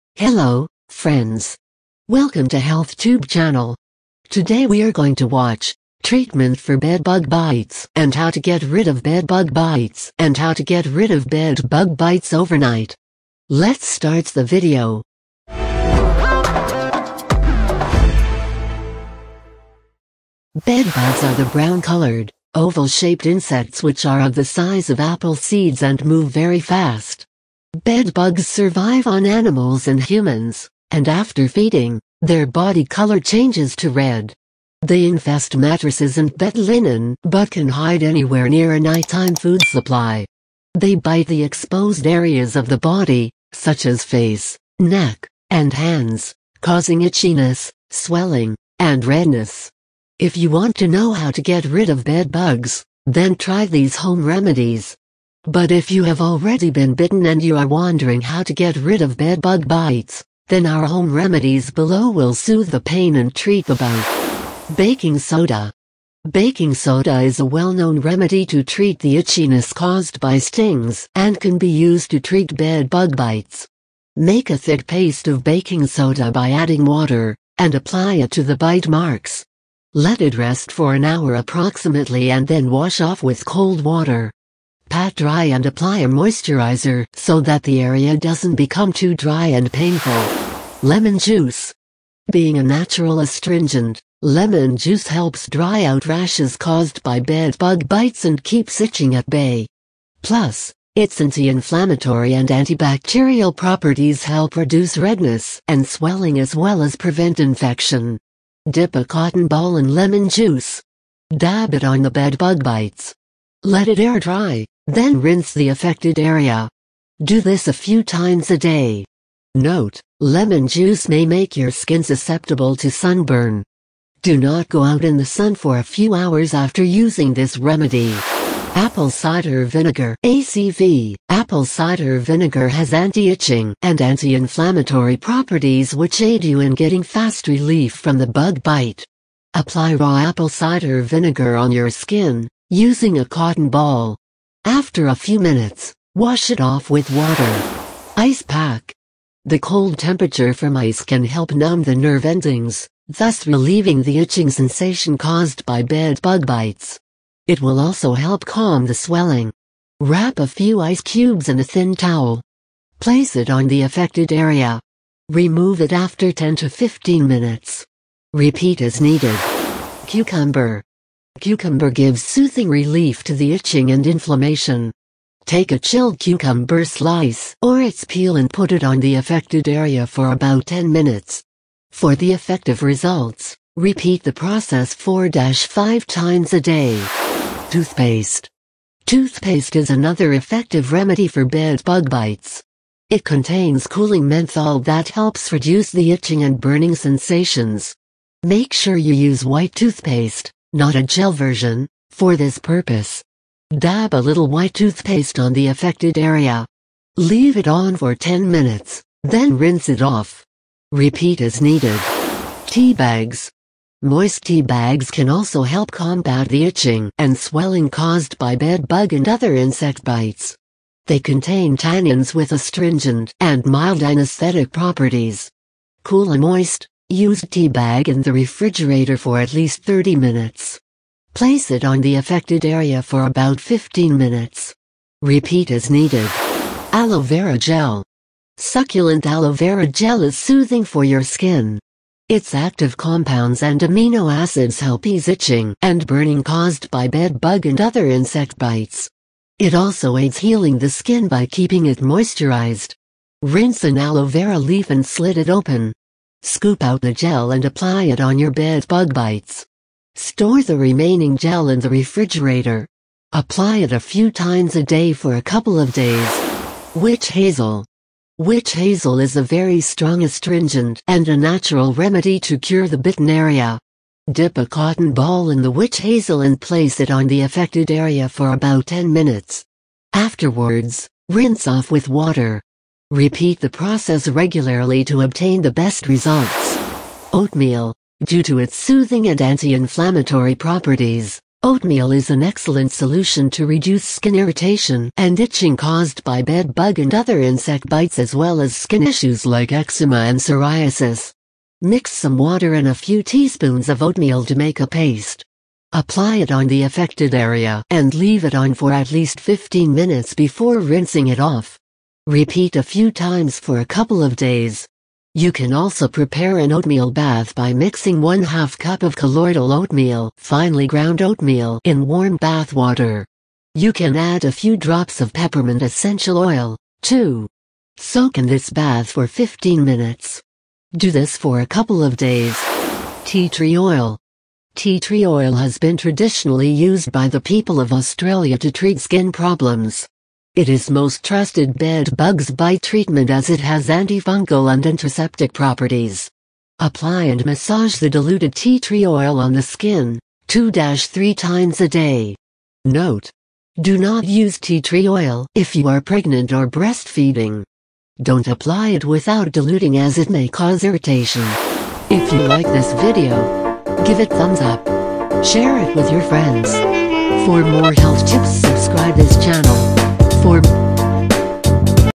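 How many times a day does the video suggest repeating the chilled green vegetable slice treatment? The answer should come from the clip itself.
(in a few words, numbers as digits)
4-5.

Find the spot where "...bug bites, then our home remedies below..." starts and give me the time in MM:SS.
00:59.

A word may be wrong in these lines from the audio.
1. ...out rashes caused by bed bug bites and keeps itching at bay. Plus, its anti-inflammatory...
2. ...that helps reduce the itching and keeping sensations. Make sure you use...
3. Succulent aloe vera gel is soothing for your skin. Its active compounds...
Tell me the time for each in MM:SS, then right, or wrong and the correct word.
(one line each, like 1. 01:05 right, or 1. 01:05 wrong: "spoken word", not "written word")
1. 01:35 right
2. 03:14 wrong: "burning", not "keeping"
3. 03:58 right.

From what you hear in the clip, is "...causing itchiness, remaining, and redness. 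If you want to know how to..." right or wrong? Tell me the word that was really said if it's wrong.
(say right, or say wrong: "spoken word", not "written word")
wrong: "swelling", not "remaining".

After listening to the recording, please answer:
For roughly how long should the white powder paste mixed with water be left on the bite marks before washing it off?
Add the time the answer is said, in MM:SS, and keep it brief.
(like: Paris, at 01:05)
an hour, at 01:20.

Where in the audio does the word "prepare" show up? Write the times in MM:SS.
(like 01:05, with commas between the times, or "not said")
05:16.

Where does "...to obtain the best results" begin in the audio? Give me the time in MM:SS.
04:45.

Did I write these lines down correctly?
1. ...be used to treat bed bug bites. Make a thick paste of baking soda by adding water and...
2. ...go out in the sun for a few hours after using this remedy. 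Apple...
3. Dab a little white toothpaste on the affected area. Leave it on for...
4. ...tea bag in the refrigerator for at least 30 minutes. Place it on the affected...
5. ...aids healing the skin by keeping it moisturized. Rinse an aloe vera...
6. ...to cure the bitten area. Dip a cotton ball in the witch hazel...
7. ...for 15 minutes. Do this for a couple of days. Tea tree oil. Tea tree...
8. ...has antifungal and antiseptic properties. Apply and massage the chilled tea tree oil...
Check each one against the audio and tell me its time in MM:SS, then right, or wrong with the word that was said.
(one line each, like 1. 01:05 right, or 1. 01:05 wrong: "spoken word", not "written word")
1. 01:11 right
2. 02:04 right
3. 03:23 right
4. 03:47 right
5. 04:10 right
6. 04:32 right
7. 05:29 right
8. 05:43 wrong: "diluted", not "chilled".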